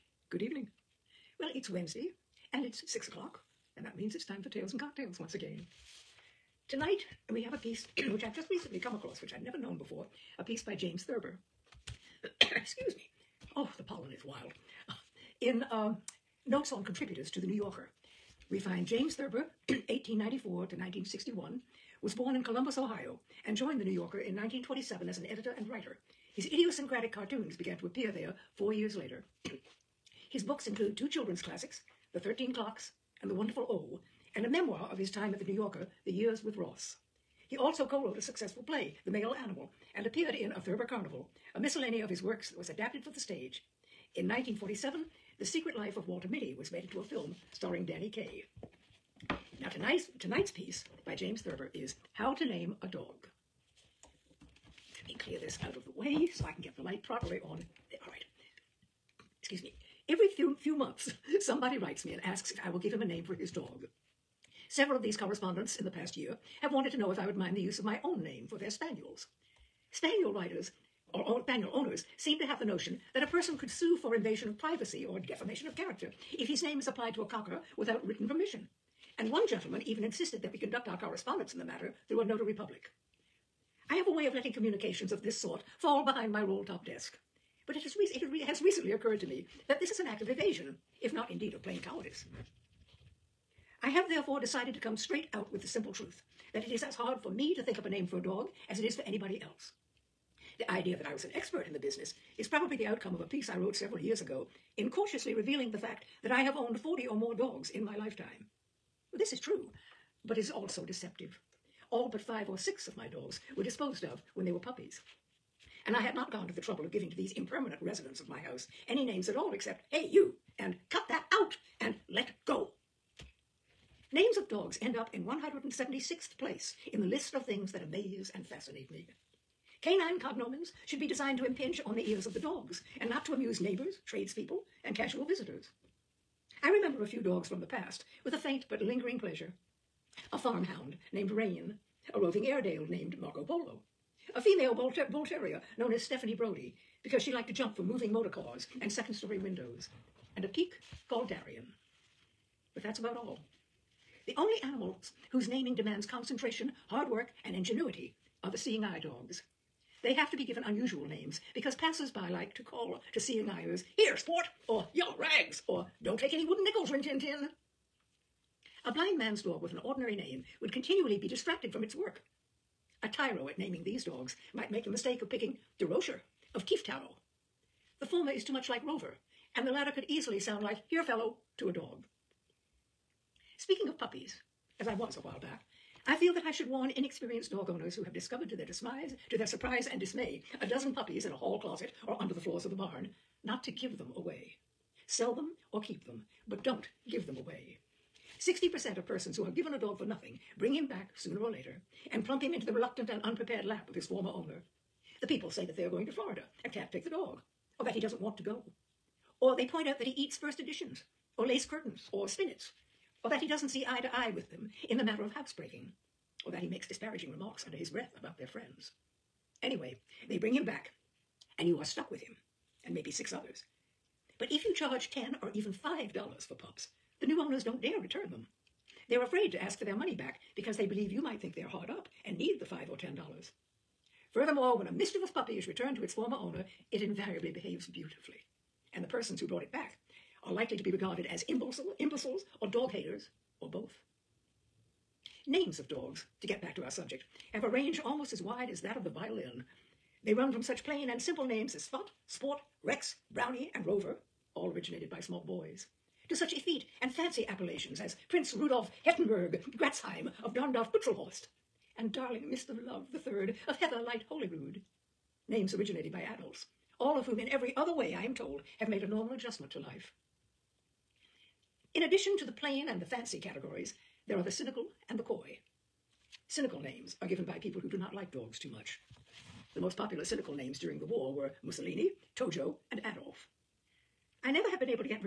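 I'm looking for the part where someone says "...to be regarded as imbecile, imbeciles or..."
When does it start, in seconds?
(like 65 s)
240 s.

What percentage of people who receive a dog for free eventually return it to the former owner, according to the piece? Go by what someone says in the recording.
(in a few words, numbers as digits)
60%.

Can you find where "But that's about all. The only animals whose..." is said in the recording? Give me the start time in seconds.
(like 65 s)
152 s.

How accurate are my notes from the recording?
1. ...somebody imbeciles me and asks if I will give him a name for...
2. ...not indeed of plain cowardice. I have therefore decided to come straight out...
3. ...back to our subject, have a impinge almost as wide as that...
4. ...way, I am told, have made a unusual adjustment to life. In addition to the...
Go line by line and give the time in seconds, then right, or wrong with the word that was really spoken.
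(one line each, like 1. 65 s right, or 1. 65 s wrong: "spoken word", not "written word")
1. 61 s wrong: "writes", not "imbeciles"
2. 91 s right
3. 246 s wrong: "range", not "impinge"
4. 267 s wrong: "normal", not "unusual".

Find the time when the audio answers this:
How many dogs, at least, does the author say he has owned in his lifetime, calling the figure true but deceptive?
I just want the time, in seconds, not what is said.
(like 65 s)
106 s.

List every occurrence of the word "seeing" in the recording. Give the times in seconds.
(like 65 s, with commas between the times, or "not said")
158 s, 163 s.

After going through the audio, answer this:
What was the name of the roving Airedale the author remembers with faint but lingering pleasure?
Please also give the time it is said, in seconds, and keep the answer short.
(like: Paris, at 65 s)
Marco Polo, at 143 s.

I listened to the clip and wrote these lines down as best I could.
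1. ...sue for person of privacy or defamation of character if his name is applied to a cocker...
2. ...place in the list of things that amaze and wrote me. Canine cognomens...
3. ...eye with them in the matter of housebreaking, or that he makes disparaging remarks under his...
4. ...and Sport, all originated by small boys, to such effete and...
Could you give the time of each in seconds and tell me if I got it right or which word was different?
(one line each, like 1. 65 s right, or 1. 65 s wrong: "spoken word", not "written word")
1. 73 s wrong: "invasion", not "person"
2. 126 s wrong: "fascinate", not "wrote"
3. 214 s right
4. 253 s wrong: "Rover", not "Sport".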